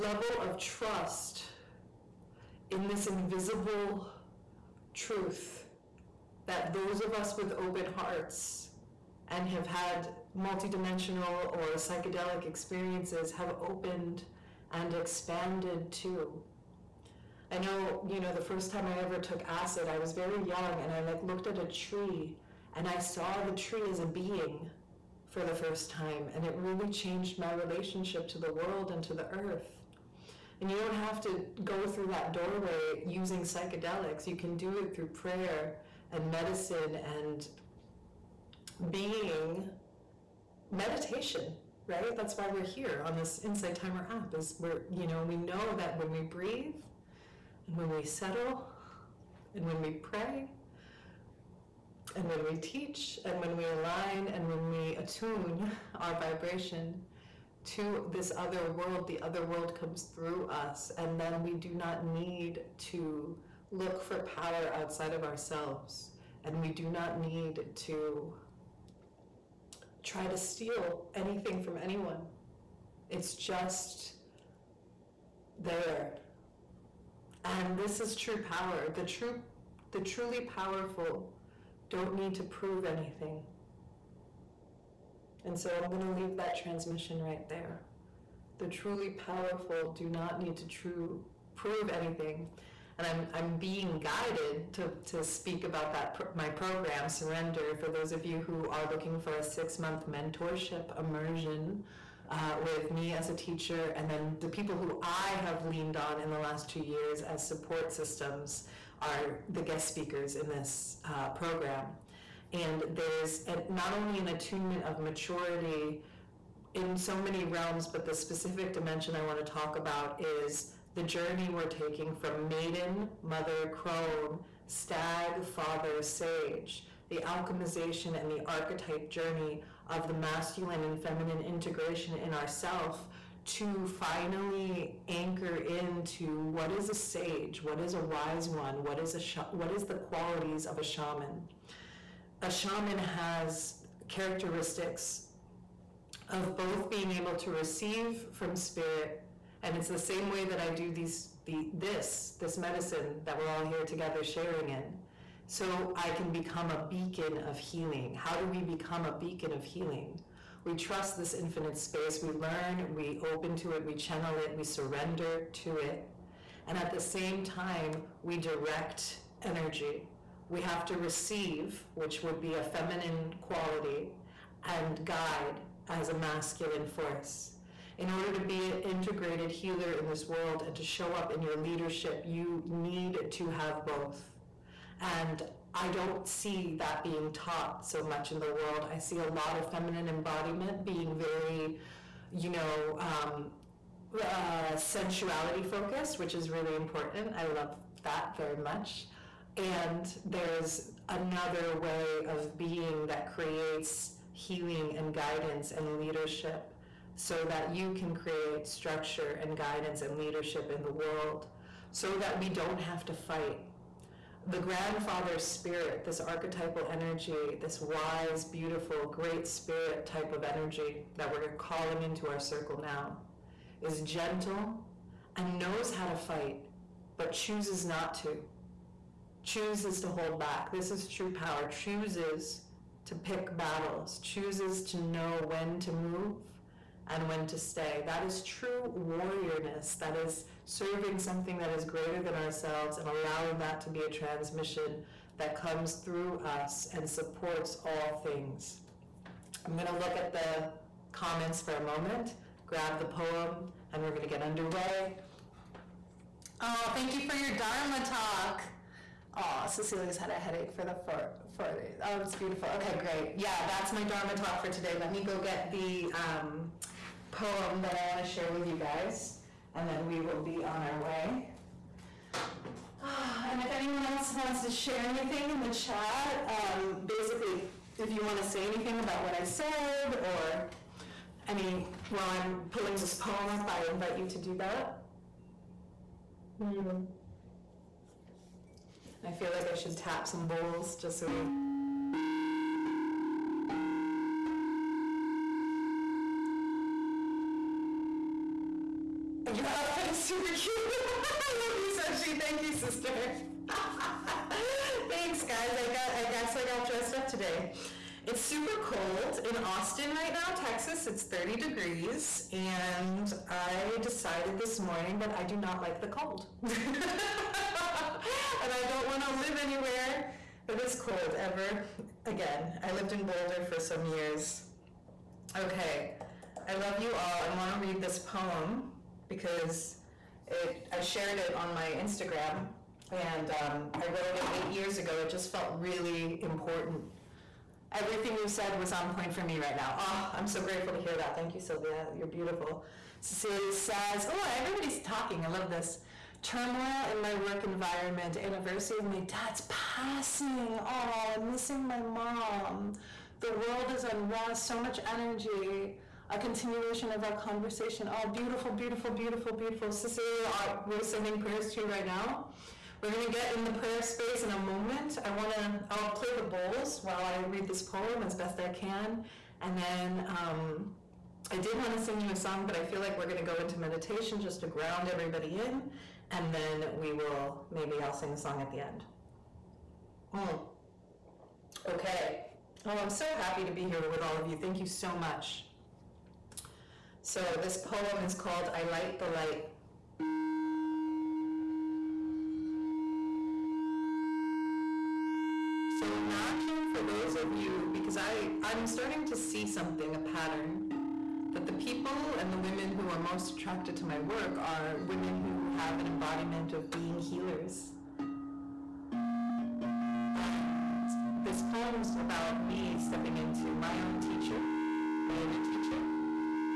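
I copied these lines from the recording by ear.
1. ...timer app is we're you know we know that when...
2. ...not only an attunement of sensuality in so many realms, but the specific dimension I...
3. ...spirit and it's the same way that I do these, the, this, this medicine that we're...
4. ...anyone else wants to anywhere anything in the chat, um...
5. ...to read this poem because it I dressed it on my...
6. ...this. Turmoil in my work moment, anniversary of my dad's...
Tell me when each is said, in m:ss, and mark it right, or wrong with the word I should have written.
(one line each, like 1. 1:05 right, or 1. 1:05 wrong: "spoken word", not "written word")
1. 0:43 right
2. 1:53 wrong: "maturity", not "sensuality"
3. 2:28 right
4. 4:33 wrong: "share", not "anywhere"
5. 5:27 wrong: "shared", not "dressed"
6. 5:45 wrong: "environment", not "moment".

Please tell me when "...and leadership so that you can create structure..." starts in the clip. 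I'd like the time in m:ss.
3:25.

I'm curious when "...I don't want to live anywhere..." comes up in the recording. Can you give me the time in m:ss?
5:18.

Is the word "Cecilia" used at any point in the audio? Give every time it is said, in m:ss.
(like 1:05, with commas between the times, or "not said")
4:19, 5:43, 5:59.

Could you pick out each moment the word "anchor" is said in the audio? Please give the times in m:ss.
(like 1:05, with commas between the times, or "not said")
2:15.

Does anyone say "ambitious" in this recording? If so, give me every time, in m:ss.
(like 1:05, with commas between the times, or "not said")
not said.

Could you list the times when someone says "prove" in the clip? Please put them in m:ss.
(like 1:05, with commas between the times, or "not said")
1:22, 1:31.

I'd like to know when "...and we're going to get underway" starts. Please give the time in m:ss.
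4:13.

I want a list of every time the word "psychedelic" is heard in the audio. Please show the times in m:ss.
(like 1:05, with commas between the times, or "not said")
0:11, 0:33.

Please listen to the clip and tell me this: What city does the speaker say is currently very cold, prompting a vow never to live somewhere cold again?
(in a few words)
Austin.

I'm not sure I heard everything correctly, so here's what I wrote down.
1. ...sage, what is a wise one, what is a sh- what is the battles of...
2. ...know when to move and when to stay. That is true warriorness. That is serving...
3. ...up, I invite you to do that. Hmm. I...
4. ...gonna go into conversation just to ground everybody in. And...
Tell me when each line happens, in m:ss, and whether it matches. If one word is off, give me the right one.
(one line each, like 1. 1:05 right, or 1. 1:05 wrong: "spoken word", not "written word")
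1. 2:16 wrong: "qualities", not "battles"
2. 3:55 right
3. 4:43 right
4. 6:13 wrong: "meditation", not "conversation".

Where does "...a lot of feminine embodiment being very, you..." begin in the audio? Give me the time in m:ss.
3:09.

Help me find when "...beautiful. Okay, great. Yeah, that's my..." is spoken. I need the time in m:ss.
4:22.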